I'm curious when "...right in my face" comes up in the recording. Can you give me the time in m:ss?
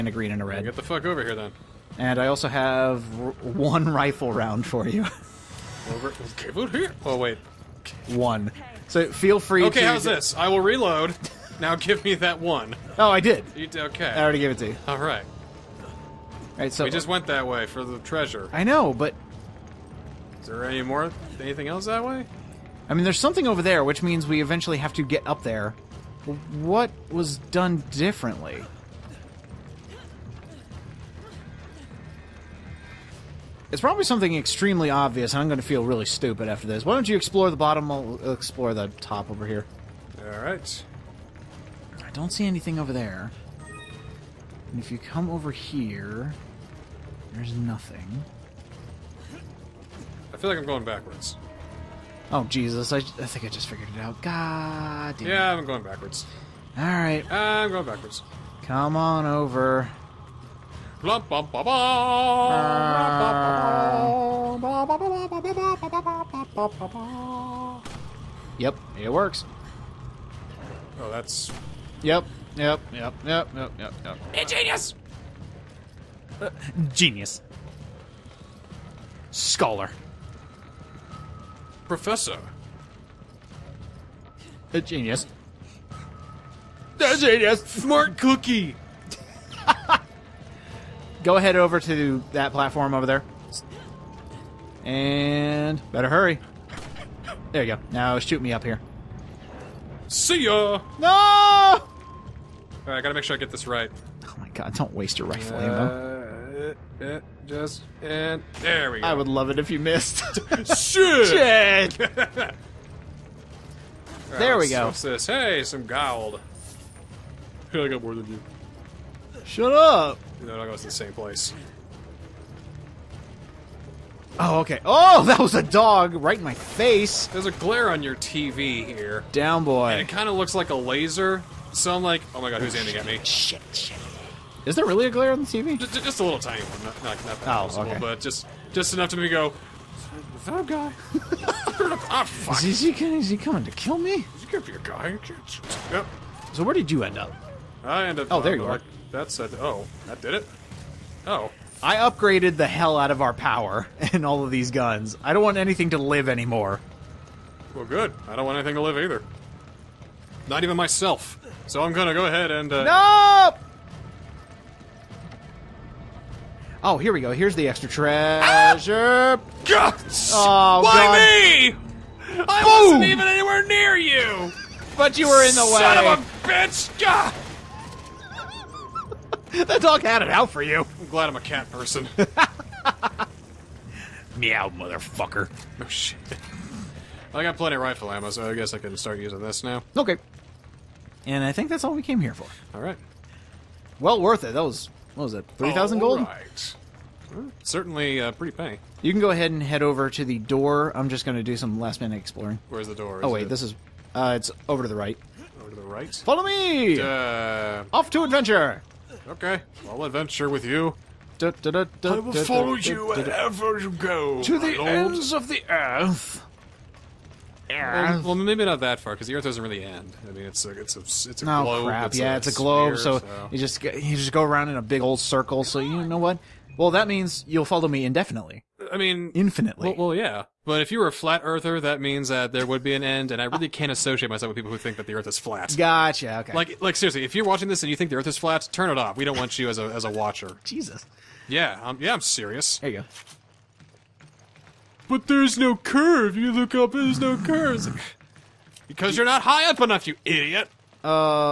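2:06.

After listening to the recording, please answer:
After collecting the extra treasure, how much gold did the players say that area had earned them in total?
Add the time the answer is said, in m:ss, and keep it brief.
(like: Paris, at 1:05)
3000 gold, at 3:15.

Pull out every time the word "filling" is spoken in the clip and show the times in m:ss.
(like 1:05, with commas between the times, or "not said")
not said.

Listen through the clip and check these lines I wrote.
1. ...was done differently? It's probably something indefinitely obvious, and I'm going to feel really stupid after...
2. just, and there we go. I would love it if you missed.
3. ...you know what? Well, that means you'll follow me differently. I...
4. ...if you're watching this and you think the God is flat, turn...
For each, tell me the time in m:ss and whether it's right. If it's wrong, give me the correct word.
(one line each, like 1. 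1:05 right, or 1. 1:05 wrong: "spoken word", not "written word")
1. 0:27 wrong: "extremely", not "indefinitely"
2. 1:47 right
3. 3:45 wrong: "indefinitely", not "differently"
4. 3:57 wrong: "Earth", not "God".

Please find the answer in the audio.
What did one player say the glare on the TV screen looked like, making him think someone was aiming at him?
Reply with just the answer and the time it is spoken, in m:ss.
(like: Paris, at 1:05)
A laser, at 2:10.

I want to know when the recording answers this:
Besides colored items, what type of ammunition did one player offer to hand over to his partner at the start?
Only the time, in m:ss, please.
0:03.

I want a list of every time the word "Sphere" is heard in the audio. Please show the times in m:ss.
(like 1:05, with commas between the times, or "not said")
3:42.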